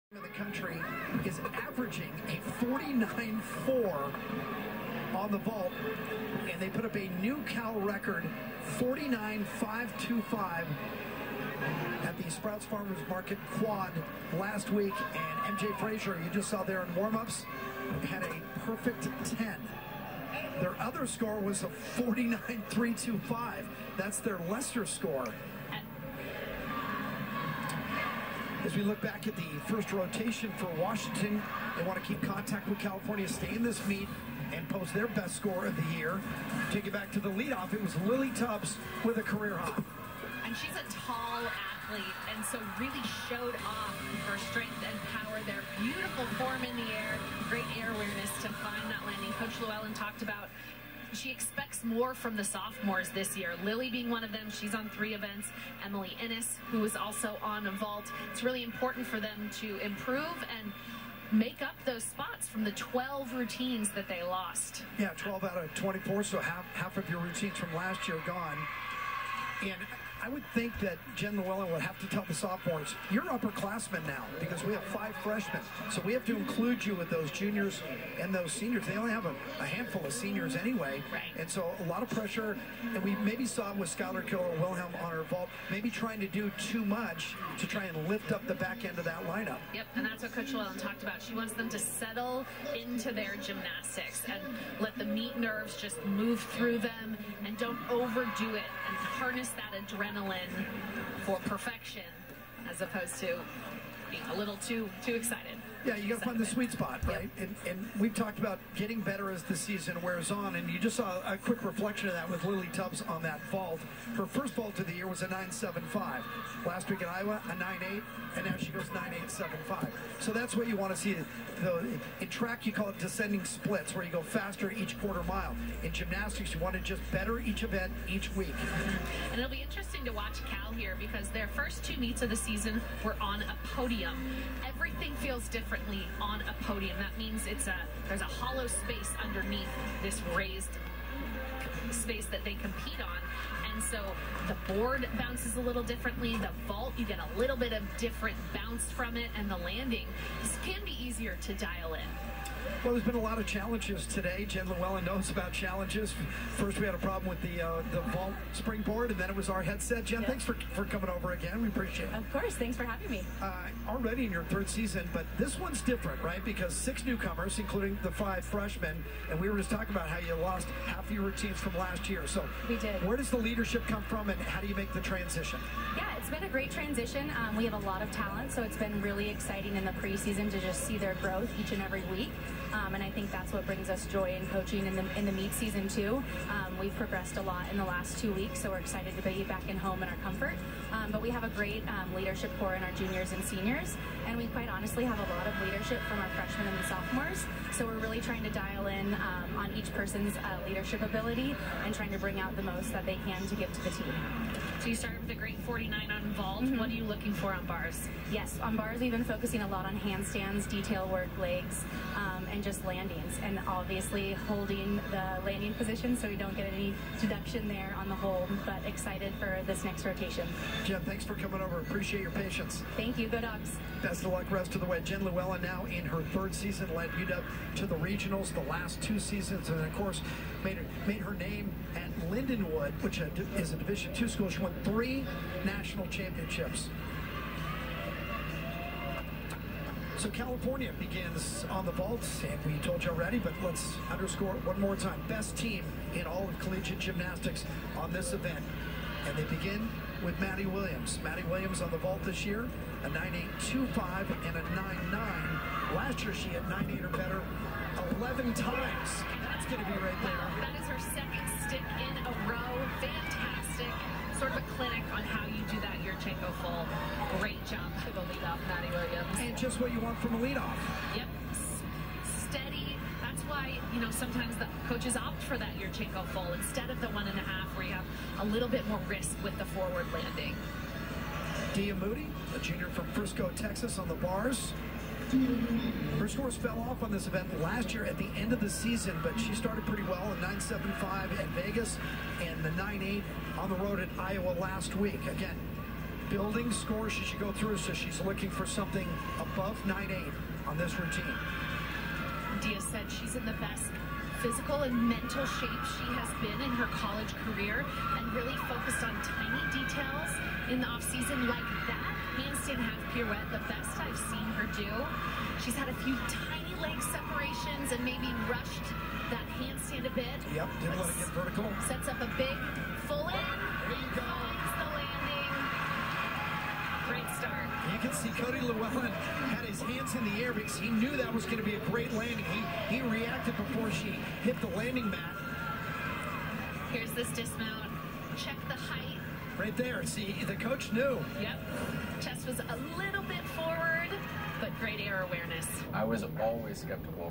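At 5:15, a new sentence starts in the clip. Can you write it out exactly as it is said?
She's had a few tiny leg separations and maybe rushed that handstand a bit.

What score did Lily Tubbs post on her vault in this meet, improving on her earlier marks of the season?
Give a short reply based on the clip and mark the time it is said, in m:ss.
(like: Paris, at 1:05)
9.875, at 1:58.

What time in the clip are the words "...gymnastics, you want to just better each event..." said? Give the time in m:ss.
2:05.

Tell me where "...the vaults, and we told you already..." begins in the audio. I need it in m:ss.
4:01.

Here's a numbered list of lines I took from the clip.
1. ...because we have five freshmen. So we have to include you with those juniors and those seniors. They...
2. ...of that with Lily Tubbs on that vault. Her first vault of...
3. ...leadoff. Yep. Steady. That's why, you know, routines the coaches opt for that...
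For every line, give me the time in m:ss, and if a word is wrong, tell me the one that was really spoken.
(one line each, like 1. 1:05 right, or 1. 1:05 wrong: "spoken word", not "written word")
1. 1:14 right
2. 1:52 right
3. 4:30 wrong: "sometimes", not "routines".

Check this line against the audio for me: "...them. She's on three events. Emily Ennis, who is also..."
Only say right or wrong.
right.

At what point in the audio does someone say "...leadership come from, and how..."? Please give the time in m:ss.
2:53.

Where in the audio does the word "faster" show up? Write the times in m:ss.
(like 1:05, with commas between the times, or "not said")
2:04.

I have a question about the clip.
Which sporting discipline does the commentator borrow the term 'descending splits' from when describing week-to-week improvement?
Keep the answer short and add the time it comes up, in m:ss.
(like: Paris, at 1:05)
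Track, at 2:02.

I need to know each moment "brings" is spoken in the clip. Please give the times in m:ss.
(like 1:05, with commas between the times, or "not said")
3:03, 3:22.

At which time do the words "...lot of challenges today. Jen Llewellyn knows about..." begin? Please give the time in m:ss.
2:33.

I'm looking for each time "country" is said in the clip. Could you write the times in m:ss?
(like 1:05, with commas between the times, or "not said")
0:00.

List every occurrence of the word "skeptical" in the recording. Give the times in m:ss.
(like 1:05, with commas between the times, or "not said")
5:46.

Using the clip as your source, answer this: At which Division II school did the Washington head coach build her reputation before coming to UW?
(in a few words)
Lindenwood.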